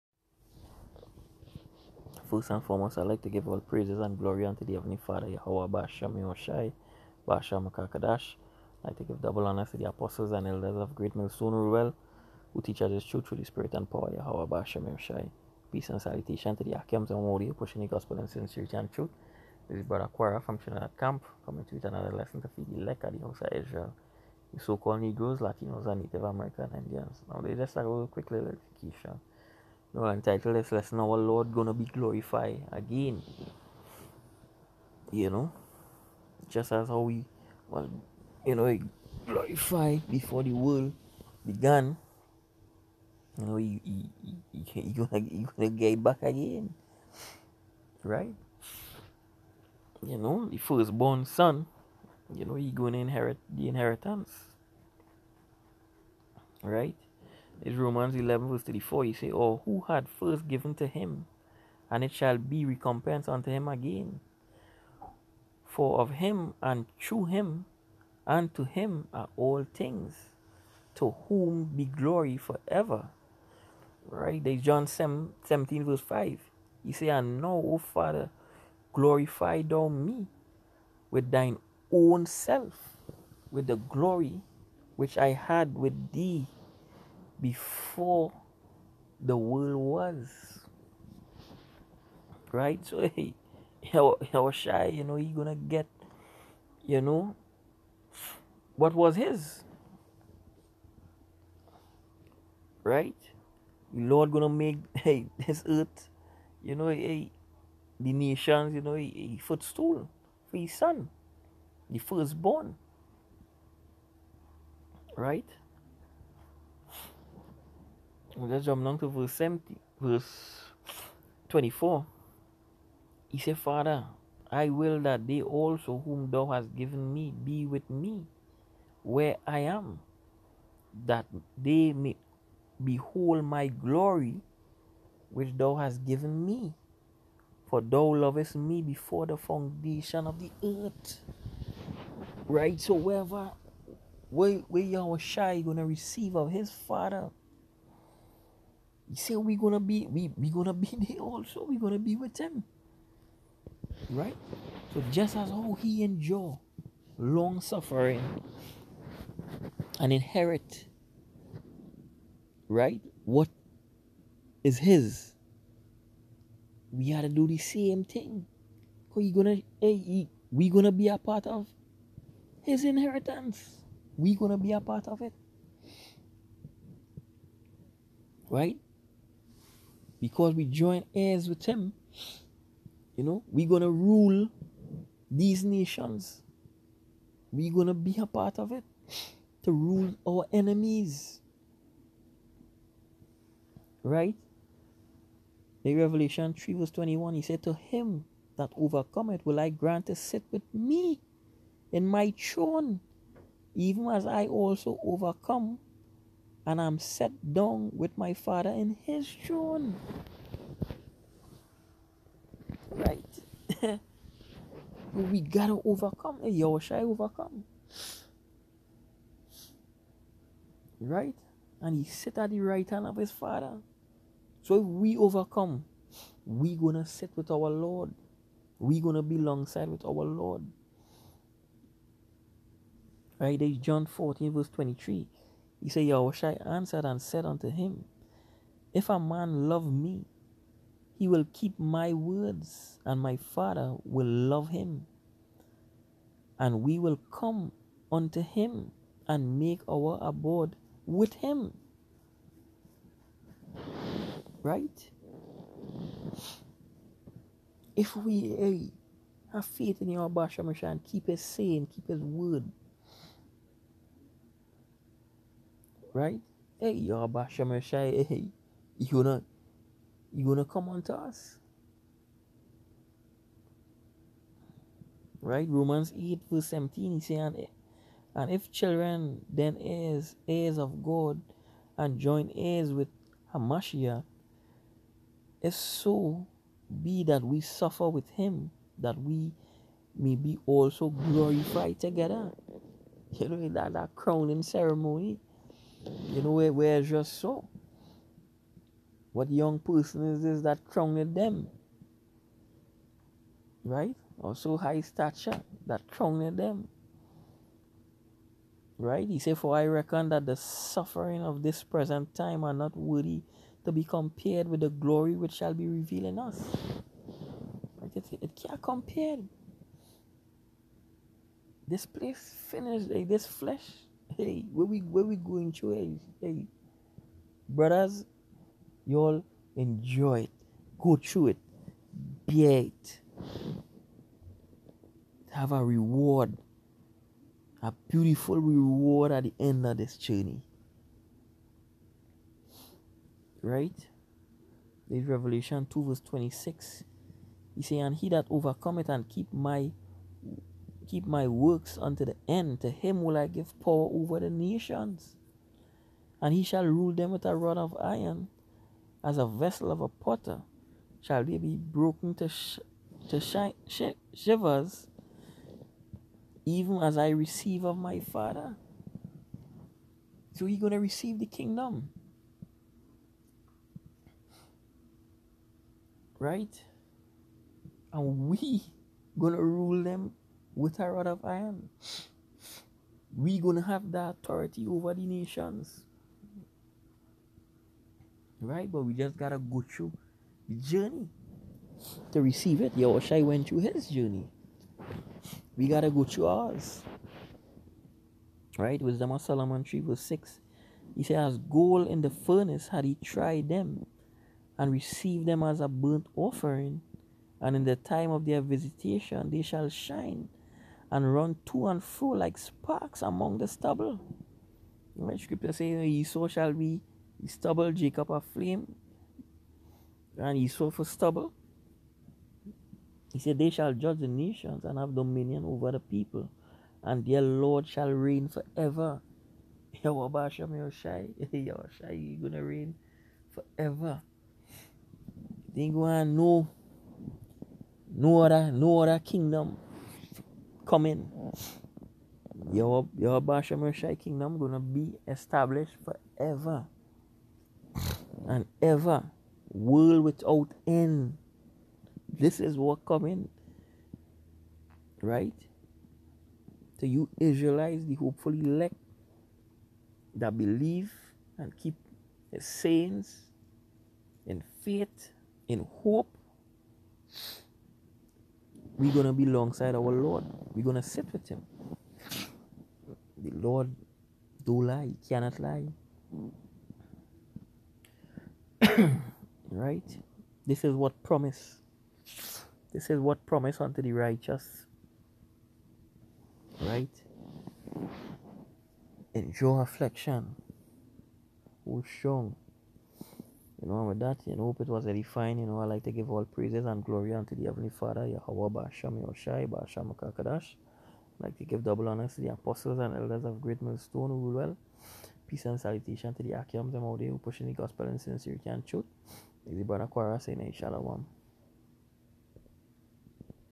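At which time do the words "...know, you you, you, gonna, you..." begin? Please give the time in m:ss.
0:43.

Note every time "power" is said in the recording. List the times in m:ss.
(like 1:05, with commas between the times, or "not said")
0:13, 5:53.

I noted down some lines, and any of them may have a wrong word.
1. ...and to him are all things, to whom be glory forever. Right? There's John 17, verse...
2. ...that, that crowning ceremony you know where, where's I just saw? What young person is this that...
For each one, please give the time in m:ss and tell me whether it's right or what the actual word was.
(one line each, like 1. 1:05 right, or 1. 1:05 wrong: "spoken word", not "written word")
1. 1:08 right
2. 4:53 right.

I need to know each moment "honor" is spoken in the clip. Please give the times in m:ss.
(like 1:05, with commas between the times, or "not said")
0:09, 8:22.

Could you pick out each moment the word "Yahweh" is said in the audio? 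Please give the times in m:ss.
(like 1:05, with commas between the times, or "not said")
0:05, 0:14, 2:24, 8:18.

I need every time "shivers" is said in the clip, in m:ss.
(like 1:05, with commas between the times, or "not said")
6:04.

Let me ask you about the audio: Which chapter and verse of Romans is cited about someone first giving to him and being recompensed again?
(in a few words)
Romans 11:34.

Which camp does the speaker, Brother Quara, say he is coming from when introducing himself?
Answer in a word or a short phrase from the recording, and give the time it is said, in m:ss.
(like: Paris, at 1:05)
Trinidad Camp, at 0:20.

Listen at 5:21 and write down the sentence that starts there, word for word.
This place finished, like this flesh Hey, where we where we going to?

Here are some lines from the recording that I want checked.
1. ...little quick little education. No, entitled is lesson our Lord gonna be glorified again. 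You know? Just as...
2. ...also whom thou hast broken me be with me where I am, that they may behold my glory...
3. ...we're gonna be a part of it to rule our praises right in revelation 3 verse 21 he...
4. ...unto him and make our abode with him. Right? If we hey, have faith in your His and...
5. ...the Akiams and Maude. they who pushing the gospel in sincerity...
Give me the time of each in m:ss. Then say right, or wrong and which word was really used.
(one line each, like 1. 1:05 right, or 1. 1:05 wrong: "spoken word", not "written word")
1. 0:27 right
2. 2:05 wrong: "given", not "broken"
3. 3:07 wrong: "enemies", not "praises"
4. 4:08 wrong: "Bashamasha", not "His"
5. 8:26 right.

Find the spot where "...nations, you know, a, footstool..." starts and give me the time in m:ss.
1:48.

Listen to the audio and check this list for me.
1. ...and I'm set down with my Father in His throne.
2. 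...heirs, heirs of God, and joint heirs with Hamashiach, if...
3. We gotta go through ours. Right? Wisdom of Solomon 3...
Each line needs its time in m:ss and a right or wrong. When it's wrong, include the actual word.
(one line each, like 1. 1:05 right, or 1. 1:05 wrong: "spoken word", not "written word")
1. 3:26 right
2. 4:39 right
3. 6:35 right.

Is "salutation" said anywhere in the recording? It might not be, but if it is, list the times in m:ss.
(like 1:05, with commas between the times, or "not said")
0:16, 8:25.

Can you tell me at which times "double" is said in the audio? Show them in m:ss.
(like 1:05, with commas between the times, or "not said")
0:09, 8:21.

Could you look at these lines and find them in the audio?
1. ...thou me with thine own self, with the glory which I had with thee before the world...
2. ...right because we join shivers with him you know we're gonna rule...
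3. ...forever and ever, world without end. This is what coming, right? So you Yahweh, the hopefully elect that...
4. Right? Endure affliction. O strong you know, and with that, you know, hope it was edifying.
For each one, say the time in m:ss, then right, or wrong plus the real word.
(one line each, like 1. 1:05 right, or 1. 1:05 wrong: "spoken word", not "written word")
1. 1:19 right
2. 2:58 wrong: "heirs", not "shivers"
3. 7:26 wrong: "Israelites", not "Yahweh"
4. 8:06 right.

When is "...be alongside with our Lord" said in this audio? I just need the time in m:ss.
3:49.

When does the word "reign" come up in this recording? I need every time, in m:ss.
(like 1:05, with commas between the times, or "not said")
7:08, 7:12.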